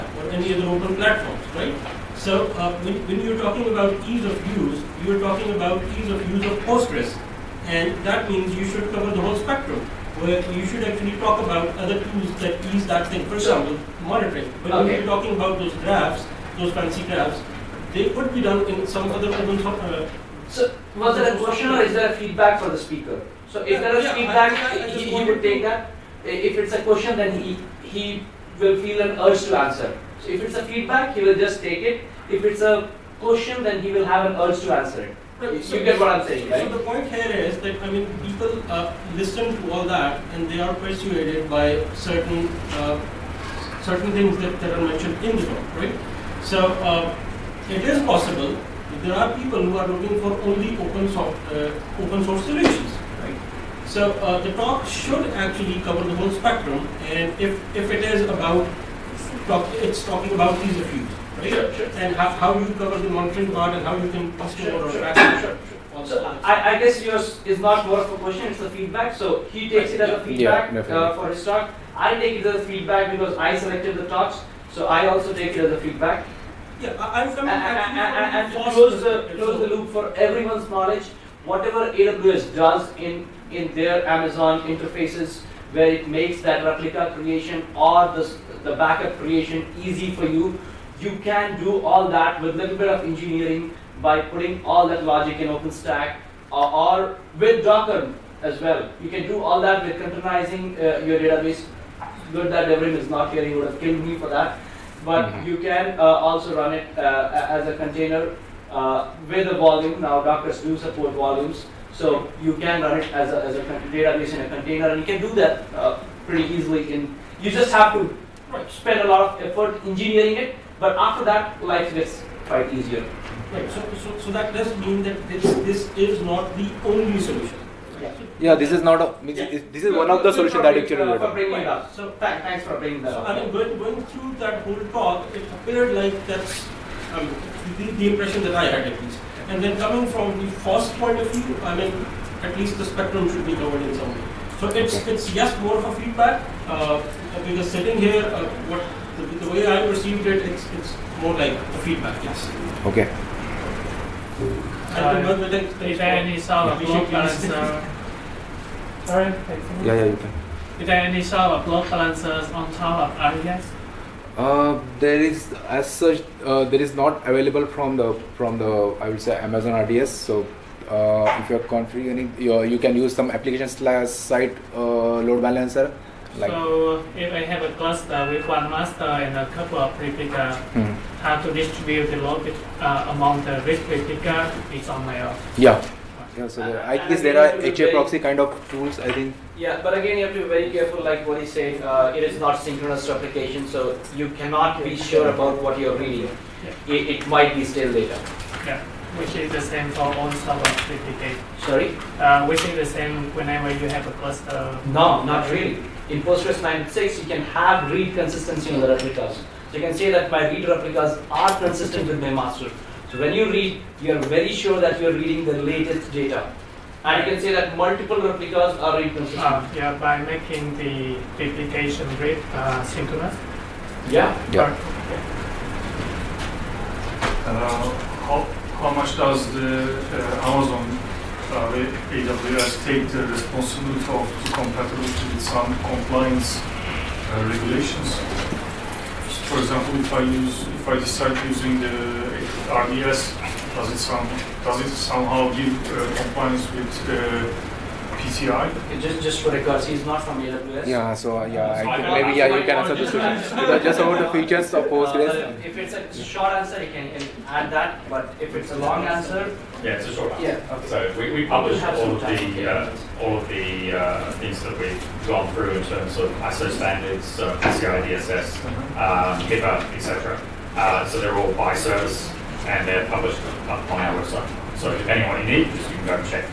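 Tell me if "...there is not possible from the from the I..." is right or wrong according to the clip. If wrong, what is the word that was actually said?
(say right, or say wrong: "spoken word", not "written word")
wrong: "available", not "possible".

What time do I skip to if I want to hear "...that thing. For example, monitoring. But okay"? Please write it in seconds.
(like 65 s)
12 s.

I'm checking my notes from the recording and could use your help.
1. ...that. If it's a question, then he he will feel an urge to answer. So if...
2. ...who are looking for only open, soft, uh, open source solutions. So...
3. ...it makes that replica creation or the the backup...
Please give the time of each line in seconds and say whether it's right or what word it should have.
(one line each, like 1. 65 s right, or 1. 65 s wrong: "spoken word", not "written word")
1. 25 s right
2. 49 s right
3. 85 s right.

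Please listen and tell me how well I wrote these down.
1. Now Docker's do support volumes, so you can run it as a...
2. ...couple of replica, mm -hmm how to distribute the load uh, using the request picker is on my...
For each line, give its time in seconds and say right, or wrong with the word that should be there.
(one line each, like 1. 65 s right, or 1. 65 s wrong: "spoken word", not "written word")
1. 110 s right
2. 179 s wrong: "among", not "using".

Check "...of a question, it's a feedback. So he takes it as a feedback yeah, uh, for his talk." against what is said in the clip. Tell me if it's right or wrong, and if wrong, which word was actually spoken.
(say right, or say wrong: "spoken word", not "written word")
right.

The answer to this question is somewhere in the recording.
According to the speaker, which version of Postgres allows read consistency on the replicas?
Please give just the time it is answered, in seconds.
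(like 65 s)
206 s.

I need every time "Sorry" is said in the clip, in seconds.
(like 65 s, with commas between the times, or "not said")
159 s, 201 s.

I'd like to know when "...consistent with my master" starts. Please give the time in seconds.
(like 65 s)
211 s.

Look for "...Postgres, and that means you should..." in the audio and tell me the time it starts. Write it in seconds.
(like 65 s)
6 s.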